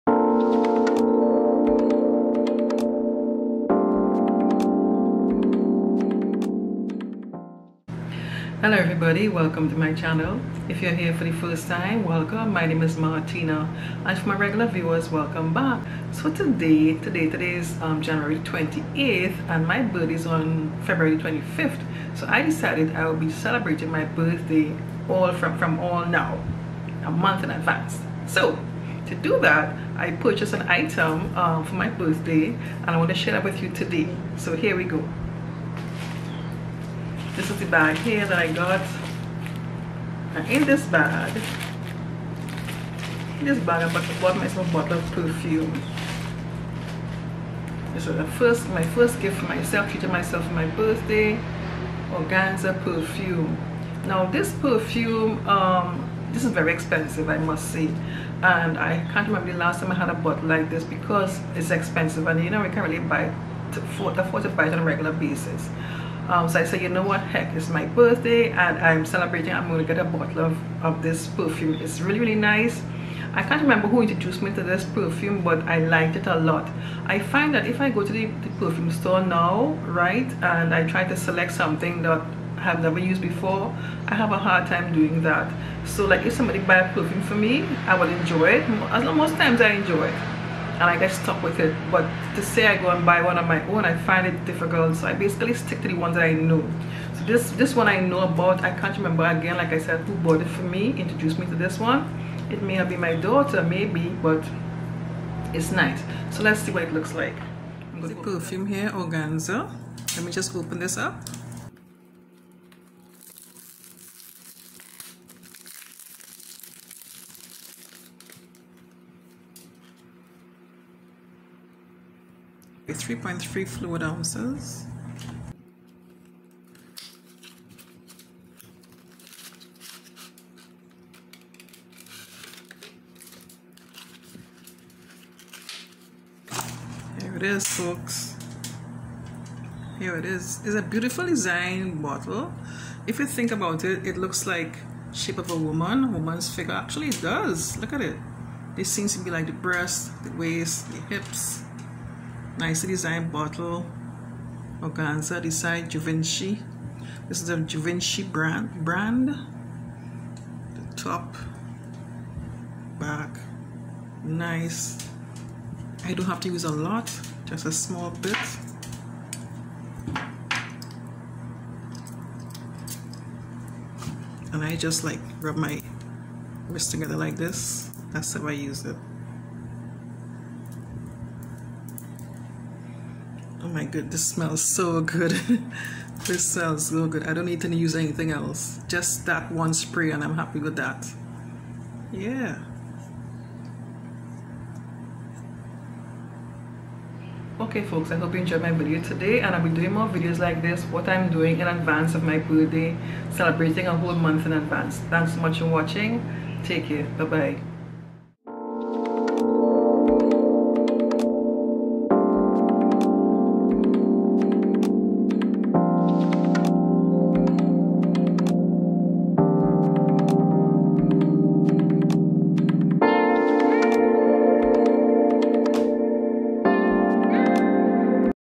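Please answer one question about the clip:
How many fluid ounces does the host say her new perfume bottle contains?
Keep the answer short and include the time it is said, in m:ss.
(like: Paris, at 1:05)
3.3, at 2:03.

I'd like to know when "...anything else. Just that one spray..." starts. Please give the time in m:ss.
3:07.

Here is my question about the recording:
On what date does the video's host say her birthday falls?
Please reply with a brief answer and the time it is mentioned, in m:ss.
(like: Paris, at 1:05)
February 25th, at 0:20.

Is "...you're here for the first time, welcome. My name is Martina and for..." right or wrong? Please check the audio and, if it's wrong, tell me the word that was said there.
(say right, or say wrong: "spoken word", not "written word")
right.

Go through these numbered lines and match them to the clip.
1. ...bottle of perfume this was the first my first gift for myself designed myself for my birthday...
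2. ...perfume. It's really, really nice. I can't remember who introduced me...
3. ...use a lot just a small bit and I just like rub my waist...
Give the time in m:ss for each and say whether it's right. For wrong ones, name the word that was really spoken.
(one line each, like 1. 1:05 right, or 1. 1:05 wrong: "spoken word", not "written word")
1. 0:44 wrong: "treated", not "designed"
2. 1:11 right
3. 2:46 wrong: "wrist", not "waist".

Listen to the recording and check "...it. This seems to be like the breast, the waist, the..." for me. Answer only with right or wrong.
right.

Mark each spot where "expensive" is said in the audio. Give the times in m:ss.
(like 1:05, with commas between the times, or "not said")
0:56, 1:01.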